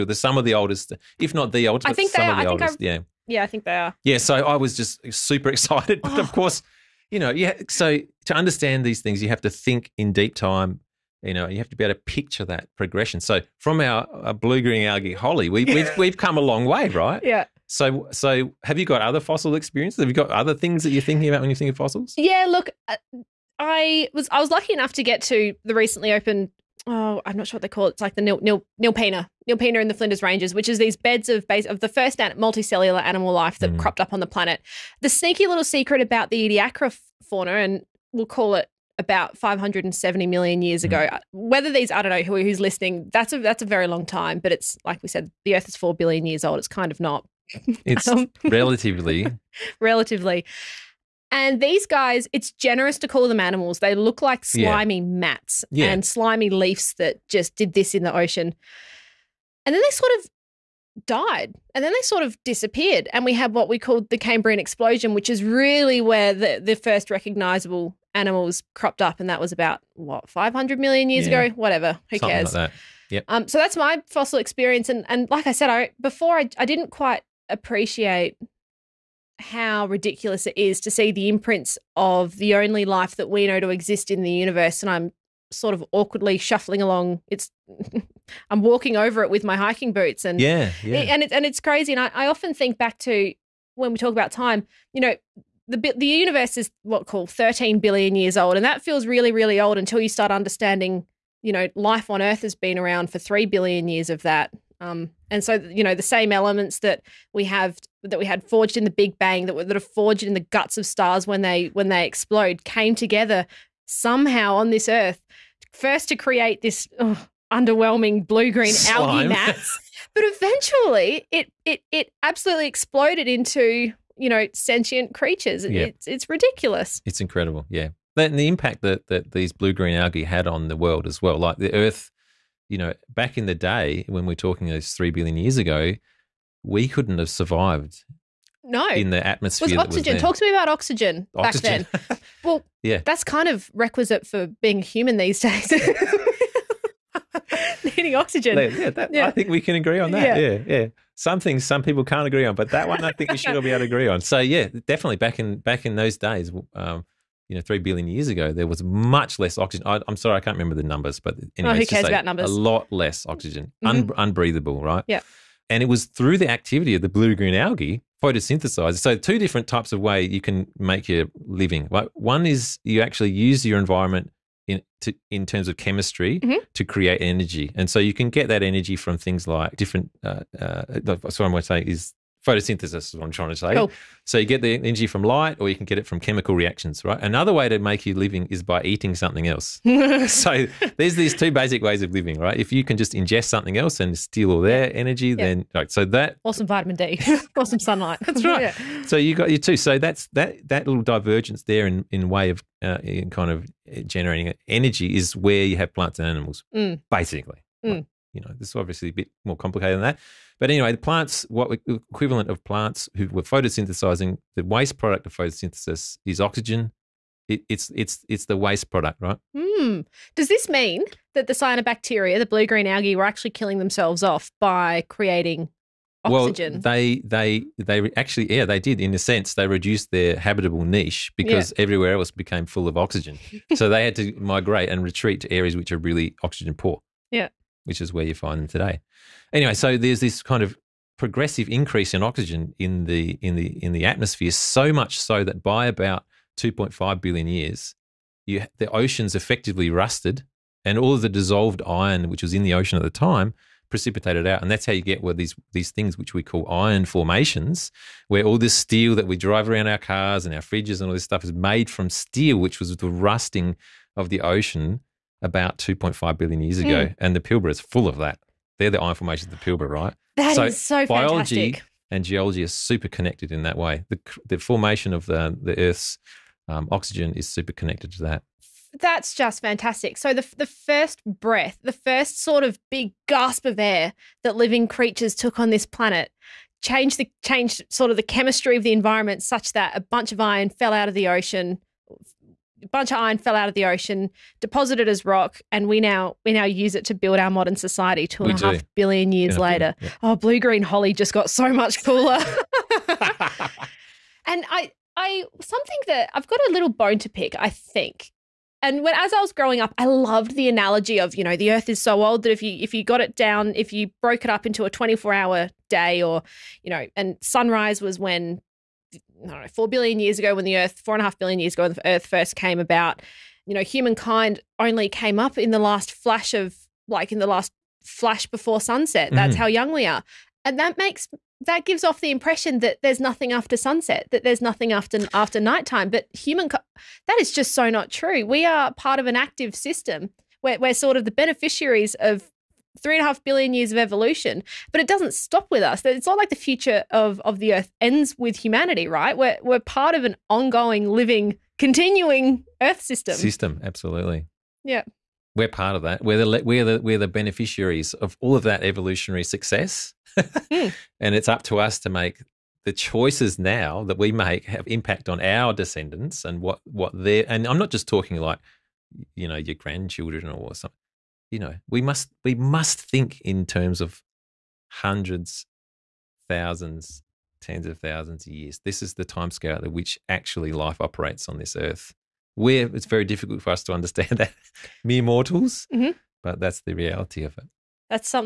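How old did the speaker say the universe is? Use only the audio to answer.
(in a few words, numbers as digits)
13 billion years.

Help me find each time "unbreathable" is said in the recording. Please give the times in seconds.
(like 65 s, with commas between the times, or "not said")
164 s.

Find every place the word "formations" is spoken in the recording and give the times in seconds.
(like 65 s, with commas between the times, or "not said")
257 s, 269 s, 274 s.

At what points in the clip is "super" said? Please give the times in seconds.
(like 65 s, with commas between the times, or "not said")
5 s, 272 s, 277 s.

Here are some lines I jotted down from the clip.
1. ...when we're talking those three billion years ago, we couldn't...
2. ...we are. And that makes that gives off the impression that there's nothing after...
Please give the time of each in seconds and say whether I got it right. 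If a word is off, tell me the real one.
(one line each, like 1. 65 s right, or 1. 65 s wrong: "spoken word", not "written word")
1. 134 s right
2. 329 s right.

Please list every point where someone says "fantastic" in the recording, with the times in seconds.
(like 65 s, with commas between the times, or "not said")
271 s, 279 s.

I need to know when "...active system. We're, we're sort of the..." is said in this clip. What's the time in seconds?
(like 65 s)
339 s.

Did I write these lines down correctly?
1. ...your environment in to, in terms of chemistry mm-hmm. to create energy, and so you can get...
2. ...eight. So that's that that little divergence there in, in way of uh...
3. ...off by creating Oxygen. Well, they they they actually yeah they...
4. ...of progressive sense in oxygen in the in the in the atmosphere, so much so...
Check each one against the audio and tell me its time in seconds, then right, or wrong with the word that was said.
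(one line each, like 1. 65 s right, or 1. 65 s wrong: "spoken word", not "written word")
1. 173 s right
2. 199 s wrong: "two", not "eight"
3. 224 s right
4. 240 s wrong: "increase", not "sense".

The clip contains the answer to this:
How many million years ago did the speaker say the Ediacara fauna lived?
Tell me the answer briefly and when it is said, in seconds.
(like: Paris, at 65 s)
570 million years, at 39 s.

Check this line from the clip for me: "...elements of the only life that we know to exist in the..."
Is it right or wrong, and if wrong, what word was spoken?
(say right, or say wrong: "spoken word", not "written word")
wrong: "imprints", not "elements".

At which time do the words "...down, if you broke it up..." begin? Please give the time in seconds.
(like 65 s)
313 s.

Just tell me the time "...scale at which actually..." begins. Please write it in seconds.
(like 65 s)
379 s.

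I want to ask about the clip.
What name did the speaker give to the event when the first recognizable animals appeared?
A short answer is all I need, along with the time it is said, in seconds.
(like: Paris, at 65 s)
Cambrian explosion, at 64 s.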